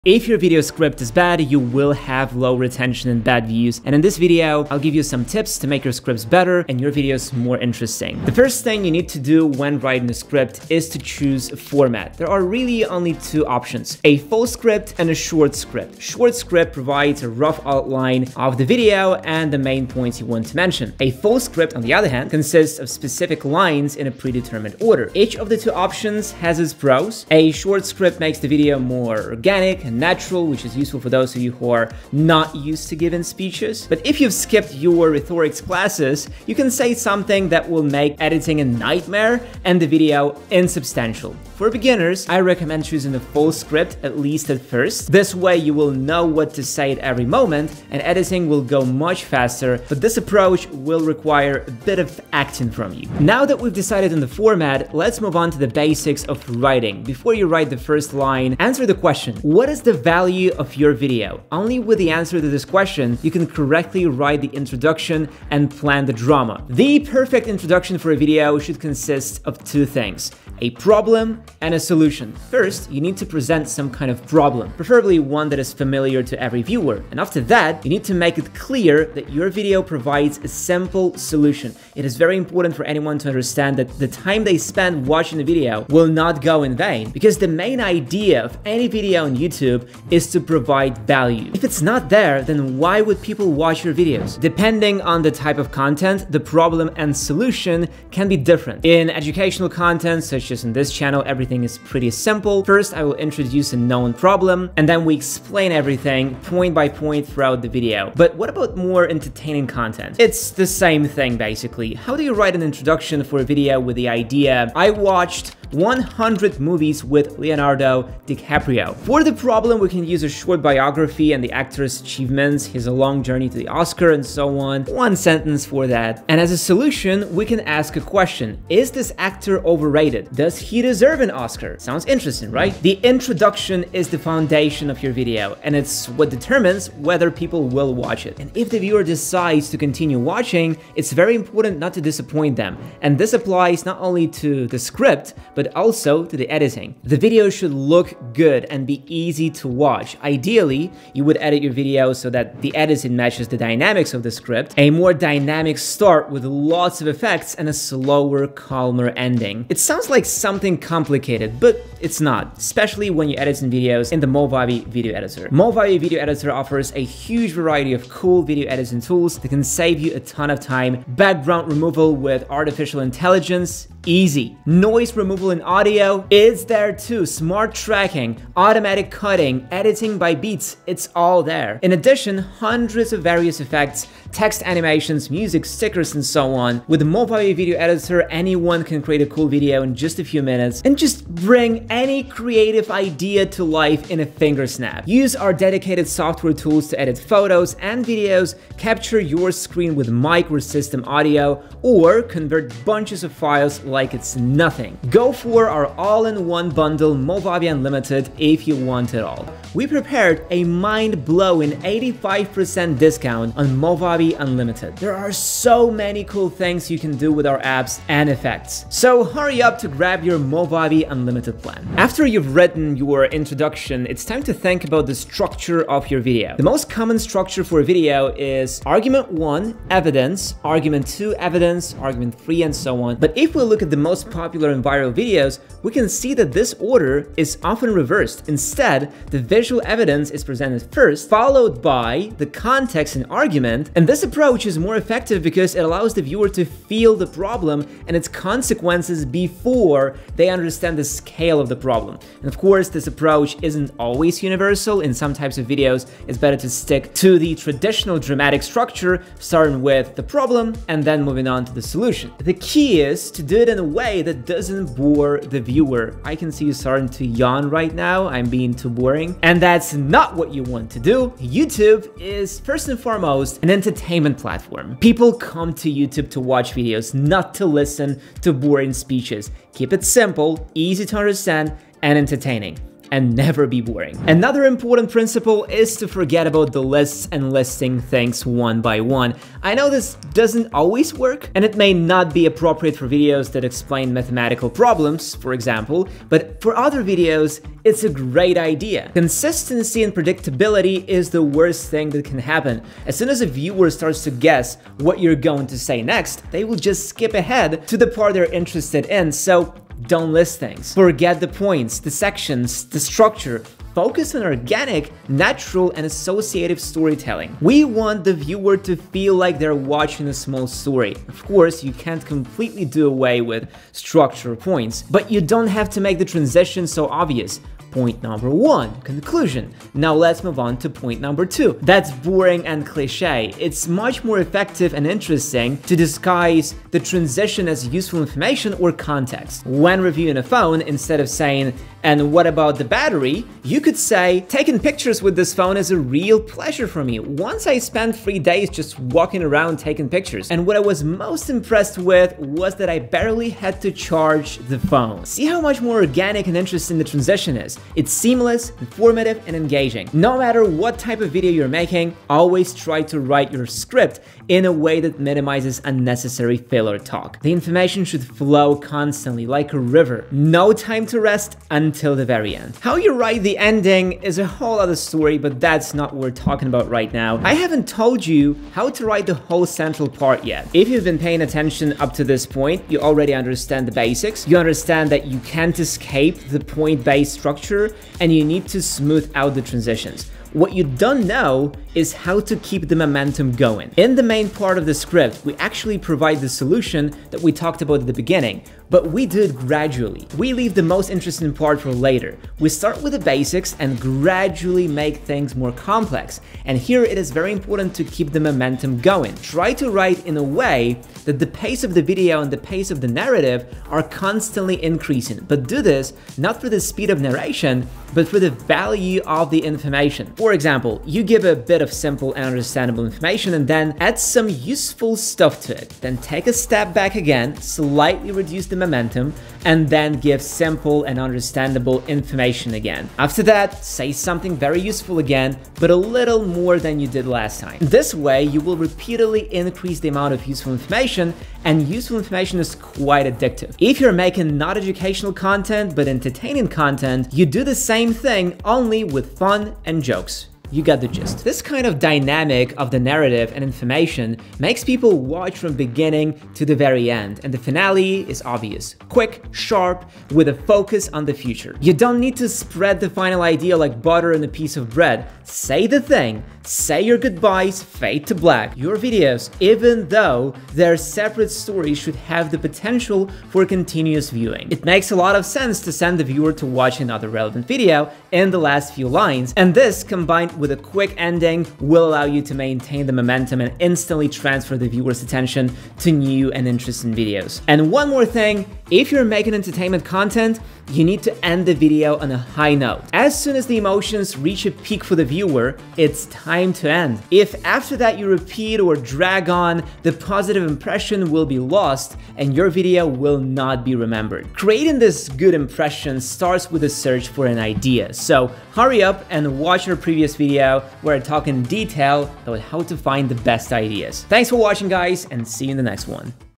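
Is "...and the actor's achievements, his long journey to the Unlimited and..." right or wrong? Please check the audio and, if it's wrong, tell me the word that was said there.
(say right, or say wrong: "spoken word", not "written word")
wrong: "Oscar", not "Unlimited".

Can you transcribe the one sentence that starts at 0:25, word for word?
Each of the two options has its pros.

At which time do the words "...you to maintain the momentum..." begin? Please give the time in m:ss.
8:02.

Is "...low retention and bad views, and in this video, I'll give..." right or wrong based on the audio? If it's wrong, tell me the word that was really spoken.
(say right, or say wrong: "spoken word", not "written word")
right.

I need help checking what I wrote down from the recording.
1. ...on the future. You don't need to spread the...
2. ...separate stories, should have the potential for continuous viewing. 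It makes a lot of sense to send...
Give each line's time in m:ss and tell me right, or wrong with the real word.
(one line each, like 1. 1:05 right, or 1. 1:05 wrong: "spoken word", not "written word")
1. 7:41 right
2. 7:50 right.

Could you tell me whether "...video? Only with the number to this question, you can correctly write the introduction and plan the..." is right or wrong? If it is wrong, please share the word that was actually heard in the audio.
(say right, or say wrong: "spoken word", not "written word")
wrong: "answer", not "number".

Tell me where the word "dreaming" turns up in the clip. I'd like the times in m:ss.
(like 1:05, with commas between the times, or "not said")
not said.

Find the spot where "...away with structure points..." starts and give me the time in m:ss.
5:23.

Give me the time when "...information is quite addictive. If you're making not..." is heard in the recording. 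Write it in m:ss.
7:22.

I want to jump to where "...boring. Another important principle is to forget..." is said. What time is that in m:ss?
4:43.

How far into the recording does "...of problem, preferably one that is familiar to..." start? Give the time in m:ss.
1:14.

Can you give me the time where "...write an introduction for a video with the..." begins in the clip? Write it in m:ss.
1:52.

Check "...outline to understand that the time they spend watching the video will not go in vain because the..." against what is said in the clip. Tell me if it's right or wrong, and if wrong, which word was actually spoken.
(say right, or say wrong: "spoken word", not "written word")
wrong: "anyone", not "outline".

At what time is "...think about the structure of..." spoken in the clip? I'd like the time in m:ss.
3:44.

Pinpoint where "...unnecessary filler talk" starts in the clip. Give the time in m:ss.
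6:05.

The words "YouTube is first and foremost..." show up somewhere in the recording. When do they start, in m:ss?
4:31.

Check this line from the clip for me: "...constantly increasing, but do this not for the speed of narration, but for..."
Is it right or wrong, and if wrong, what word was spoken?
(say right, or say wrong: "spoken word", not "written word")
right.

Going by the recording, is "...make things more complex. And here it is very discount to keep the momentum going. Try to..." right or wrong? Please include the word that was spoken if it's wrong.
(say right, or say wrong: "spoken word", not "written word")
wrong: "important", not "discount".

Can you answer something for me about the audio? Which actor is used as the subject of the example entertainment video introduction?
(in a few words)
Leonardo DiCaprio.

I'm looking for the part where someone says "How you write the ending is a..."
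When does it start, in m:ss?
6:12.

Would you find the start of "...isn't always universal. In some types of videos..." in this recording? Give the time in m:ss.
4:13.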